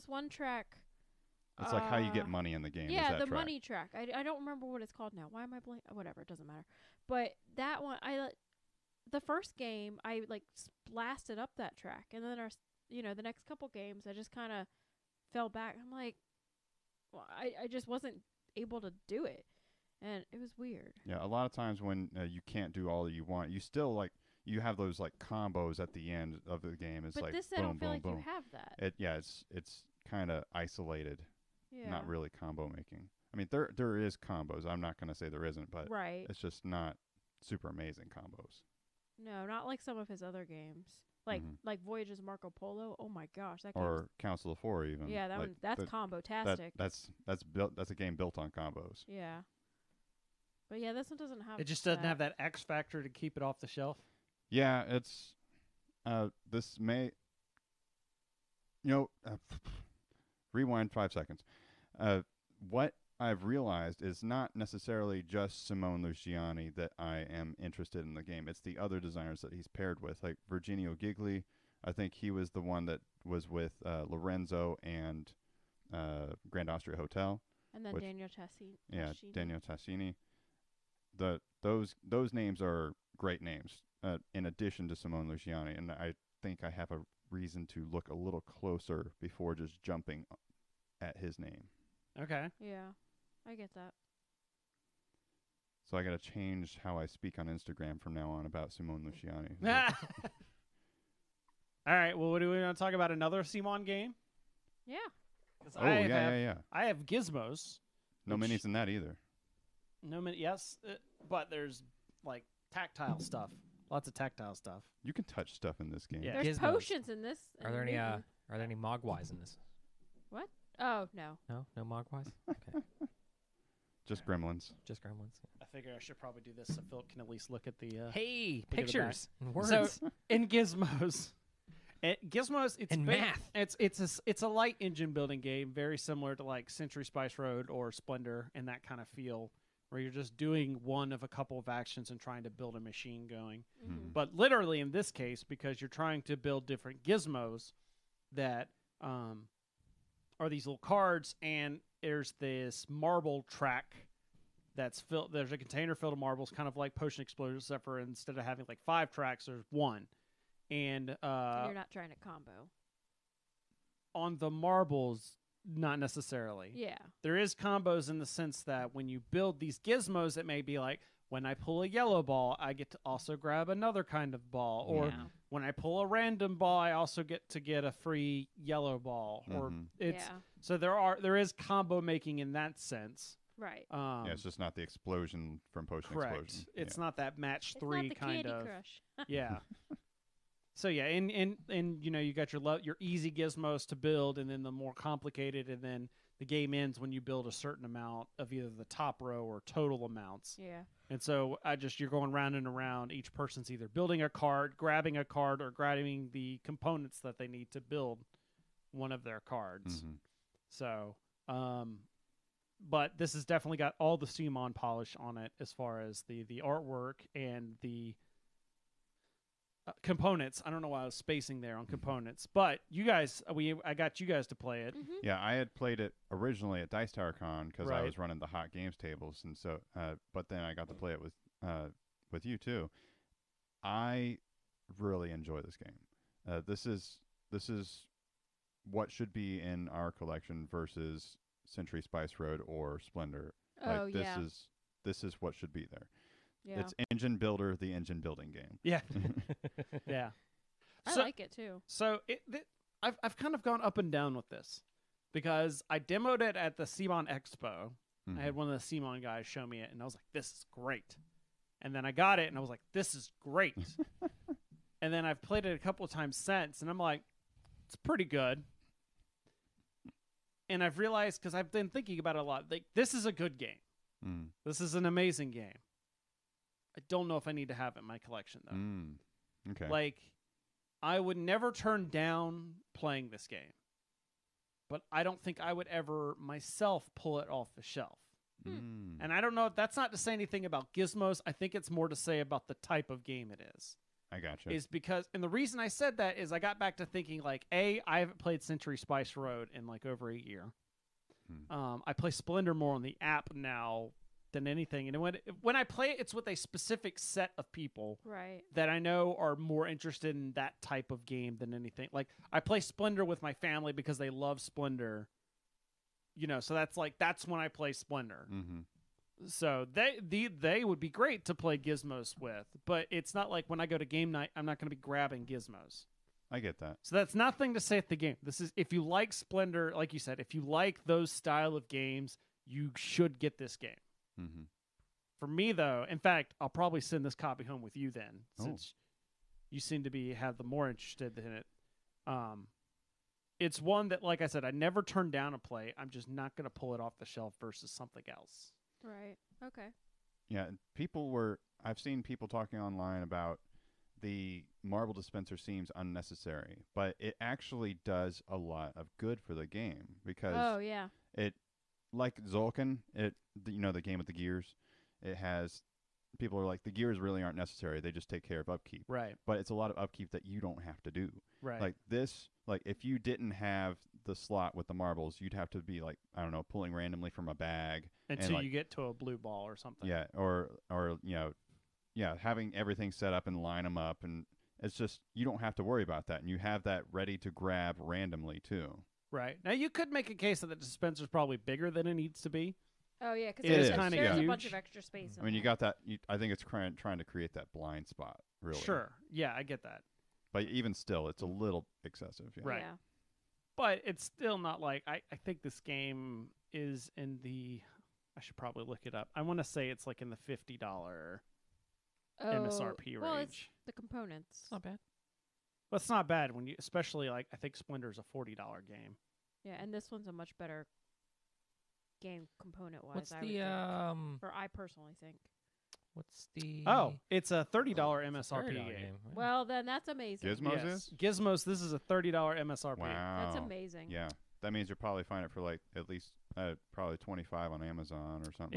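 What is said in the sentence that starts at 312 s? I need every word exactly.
Like I play Splendor with my family because they love Splendor.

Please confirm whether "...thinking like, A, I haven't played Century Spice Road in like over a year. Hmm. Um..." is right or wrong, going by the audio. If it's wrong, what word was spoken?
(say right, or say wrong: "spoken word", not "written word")
right.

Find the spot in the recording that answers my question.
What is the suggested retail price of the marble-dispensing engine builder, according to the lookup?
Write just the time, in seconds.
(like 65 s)
431 s.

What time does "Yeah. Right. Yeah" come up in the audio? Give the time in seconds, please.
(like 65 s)
402 s.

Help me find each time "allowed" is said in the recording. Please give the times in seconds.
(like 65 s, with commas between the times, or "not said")
not said.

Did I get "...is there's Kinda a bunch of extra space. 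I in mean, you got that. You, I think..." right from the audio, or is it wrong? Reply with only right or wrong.
right.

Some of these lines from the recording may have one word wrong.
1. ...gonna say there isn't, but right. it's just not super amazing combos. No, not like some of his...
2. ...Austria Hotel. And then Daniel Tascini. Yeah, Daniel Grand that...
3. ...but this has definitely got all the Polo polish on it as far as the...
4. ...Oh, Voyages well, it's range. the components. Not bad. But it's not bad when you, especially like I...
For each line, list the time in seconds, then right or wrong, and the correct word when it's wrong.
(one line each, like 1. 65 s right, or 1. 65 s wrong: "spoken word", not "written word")
1. 34 s right
2. 76 s wrong: "Tascini", not "Grand"
3. 212 s wrong: "CMON", not "Polo"
4. 412 s wrong: "MSRP", not "Voyages".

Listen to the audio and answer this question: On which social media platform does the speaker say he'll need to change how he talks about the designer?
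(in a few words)
Instagram.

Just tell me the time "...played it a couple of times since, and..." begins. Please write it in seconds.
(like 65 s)
265 s.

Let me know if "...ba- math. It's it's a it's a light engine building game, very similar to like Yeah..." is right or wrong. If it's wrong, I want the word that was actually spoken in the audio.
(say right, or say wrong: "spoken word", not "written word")
wrong: "Century", not "Yeah".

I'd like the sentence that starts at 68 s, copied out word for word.
It's the other designers that he's paired with, like Virginio Gigli.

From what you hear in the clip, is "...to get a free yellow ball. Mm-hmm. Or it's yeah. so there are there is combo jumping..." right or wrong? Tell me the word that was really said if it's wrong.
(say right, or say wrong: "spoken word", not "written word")
wrong: "making", not "jumping".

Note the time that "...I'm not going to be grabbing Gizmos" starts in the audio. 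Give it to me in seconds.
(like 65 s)
324 s.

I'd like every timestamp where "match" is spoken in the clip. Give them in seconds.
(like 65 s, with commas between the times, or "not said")
187 s.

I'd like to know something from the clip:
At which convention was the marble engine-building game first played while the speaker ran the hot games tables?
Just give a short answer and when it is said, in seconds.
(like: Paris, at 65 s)
Dice Tower Con, at 226 s.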